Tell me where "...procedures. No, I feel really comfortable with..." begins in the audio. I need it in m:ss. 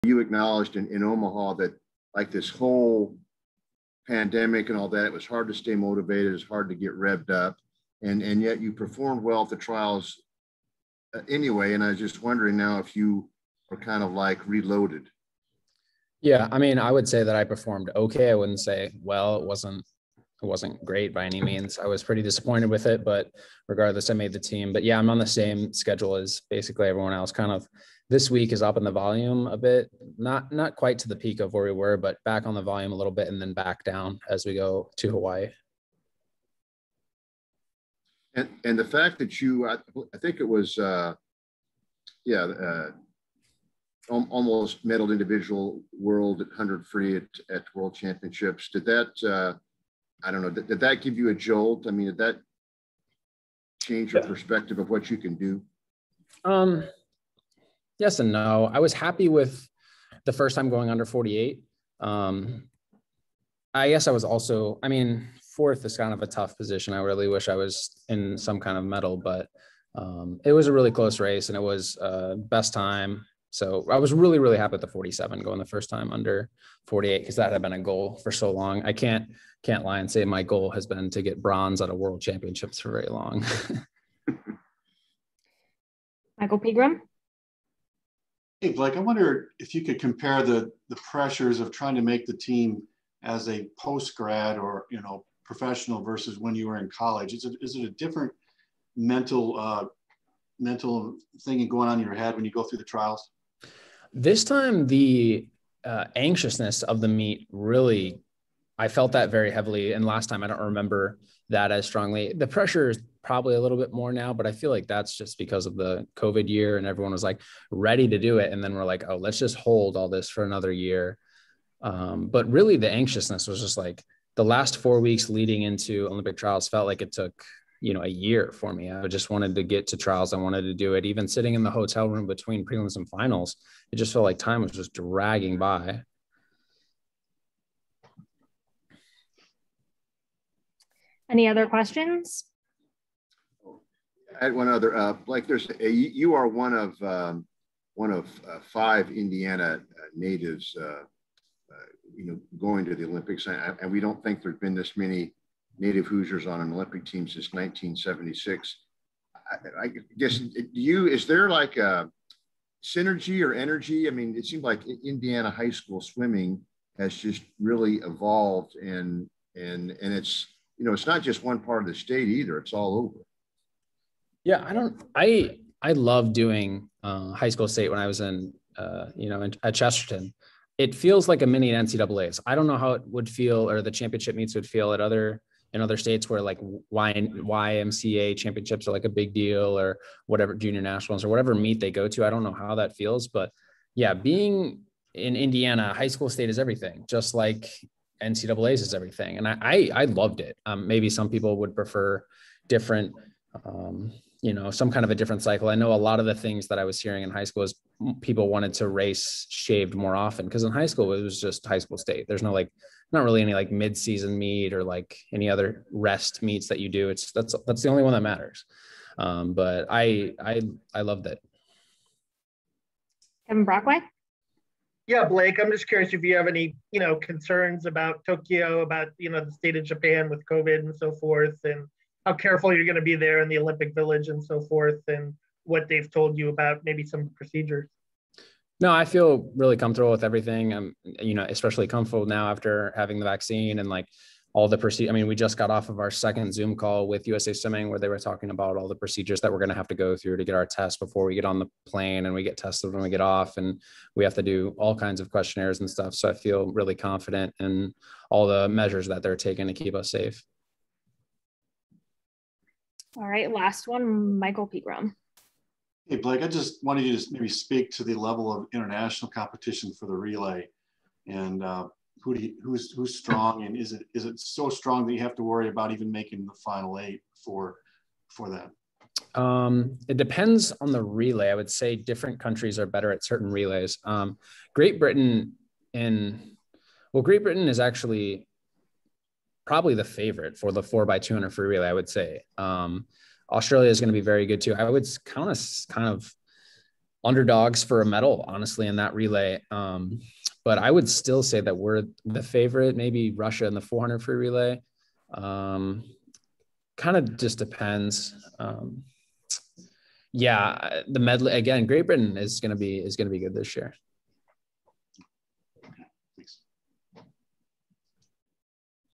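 3:57.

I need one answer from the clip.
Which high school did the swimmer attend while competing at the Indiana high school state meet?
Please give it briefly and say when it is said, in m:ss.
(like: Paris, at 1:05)
Chesterton, at 2:59.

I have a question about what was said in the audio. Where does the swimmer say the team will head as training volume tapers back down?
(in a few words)
Hawaii.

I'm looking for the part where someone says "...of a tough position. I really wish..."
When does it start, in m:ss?
1:06.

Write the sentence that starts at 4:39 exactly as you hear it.
Um, it depends on the relay.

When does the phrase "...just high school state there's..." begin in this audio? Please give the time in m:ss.
3:31.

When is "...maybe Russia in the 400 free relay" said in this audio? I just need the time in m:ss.
5:02.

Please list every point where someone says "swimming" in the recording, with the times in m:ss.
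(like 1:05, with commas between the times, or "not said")
2:46, 4:07.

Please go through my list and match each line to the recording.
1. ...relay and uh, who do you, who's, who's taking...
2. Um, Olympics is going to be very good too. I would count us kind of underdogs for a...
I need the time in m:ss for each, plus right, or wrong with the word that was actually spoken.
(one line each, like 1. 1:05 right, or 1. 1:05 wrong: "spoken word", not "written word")
1. 4:30 wrong: "strong", not "taking"
2. 4:52 wrong: "Australia", not "Olympics".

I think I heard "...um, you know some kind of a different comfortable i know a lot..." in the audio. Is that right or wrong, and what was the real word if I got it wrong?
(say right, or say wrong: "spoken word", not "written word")
wrong: "cycle", not "comfortable".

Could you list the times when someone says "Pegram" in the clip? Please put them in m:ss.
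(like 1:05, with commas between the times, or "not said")
1:26, 4:24.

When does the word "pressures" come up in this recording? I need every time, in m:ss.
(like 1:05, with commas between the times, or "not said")
1:30, 1:52.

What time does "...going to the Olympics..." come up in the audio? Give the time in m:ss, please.
2:32.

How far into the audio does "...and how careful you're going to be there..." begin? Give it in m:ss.
3:51.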